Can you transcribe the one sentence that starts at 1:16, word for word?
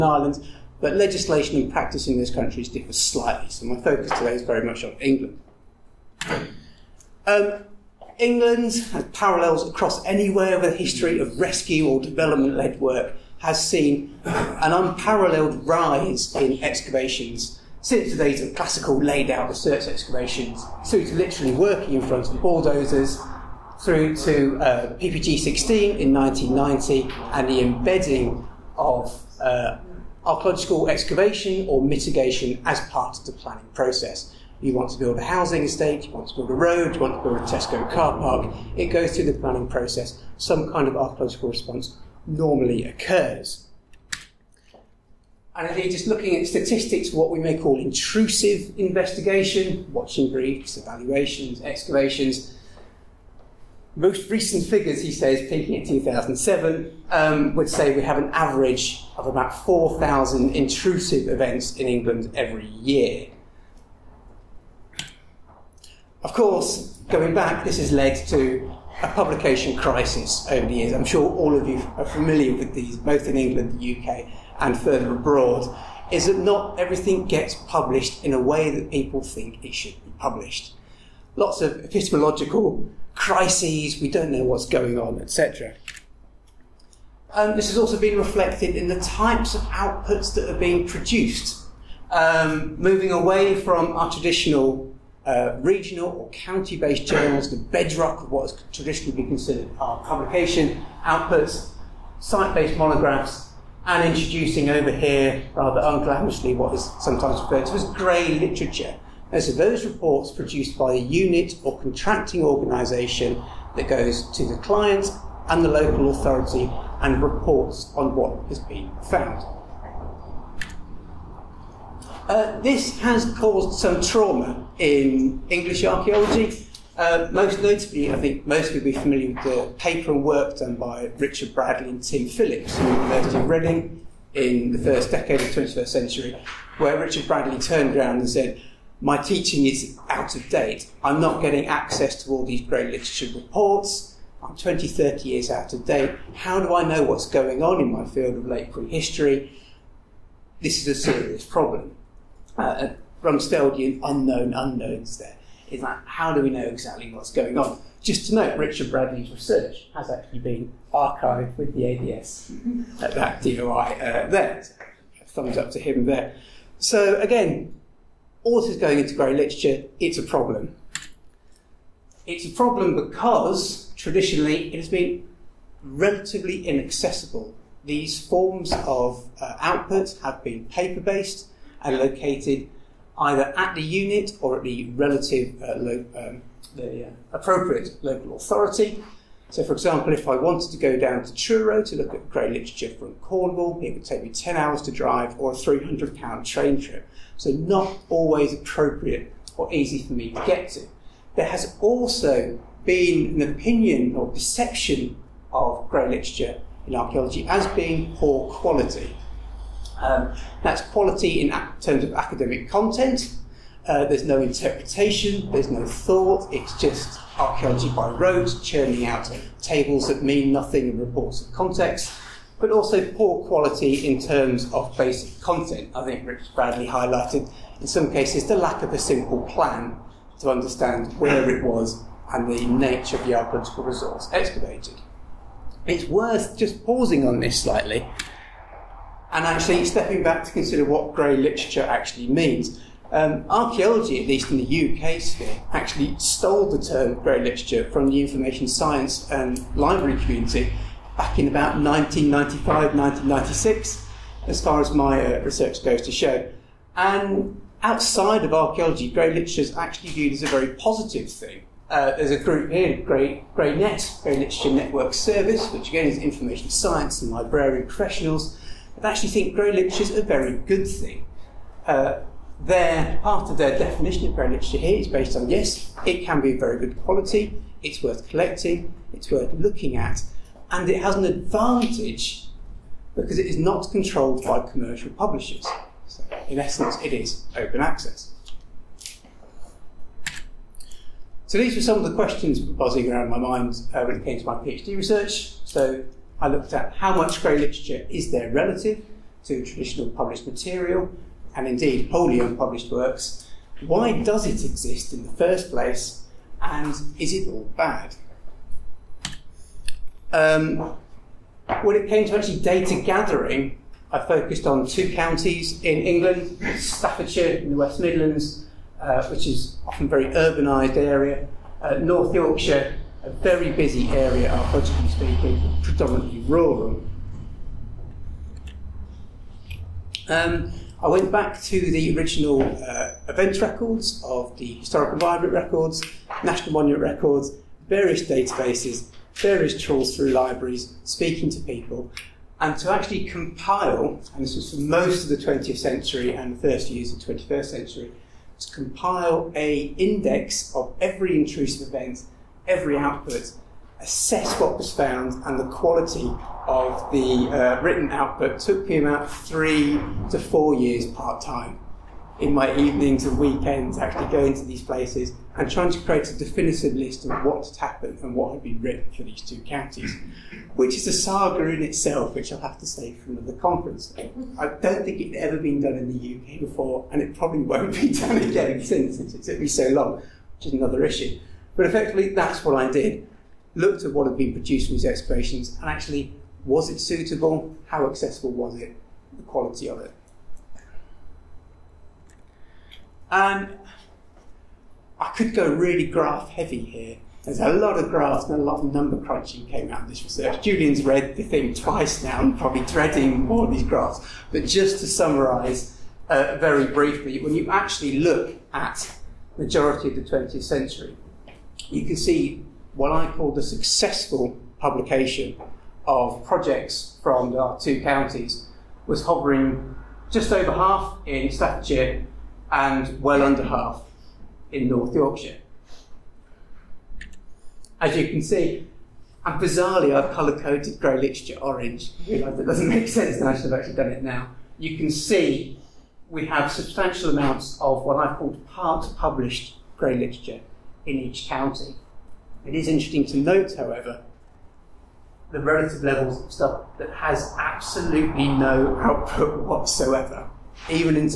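Is that not everything gets published in a way that people think it should be published?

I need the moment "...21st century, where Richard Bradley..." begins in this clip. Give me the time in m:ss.
2:15.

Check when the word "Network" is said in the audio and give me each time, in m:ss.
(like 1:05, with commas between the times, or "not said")
4:24.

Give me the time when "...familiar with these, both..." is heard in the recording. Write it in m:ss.
1:12.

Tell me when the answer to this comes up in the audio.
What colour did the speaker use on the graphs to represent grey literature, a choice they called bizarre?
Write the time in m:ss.
7:11.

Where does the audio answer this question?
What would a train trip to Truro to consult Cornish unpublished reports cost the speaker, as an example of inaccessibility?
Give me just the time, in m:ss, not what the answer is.
3:15.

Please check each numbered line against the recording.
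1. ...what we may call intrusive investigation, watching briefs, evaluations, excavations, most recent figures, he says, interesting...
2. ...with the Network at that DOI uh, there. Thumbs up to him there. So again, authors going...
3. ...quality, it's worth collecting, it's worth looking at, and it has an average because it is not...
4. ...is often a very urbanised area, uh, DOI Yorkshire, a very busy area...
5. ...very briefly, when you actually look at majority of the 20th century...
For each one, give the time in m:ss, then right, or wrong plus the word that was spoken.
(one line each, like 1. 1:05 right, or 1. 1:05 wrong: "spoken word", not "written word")
1. 0:47 wrong: "peaking", not "interesting"
2. 2:41 wrong: "ADS", not "Network"
3. 4:37 wrong: "advantage", not "average"
4. 5:19 wrong: "North", not "DOI"
5. 6:46 right.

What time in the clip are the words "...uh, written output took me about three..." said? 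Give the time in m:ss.
5:57.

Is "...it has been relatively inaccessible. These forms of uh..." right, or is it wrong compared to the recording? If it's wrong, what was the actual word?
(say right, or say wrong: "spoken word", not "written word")
right.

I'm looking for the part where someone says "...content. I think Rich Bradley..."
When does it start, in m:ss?
3:45.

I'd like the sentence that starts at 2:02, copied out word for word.
Uh, this has caused some trauma in English archaeology.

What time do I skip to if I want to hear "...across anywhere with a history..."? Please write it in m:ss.
0:09.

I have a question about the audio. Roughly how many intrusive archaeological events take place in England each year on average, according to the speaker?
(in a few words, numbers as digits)
4,000.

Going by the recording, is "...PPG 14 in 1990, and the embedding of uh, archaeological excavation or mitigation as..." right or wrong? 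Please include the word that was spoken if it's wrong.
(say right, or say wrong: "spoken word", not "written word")
wrong: "16", not "14".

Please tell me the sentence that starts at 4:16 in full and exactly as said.
And outside of archaeology, grey literature is actually viewed as a very positive thing.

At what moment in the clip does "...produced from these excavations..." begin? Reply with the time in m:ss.
6:24.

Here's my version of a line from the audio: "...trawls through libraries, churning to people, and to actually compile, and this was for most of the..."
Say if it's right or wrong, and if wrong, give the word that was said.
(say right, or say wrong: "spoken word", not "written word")
wrong: "speaking", not "churning".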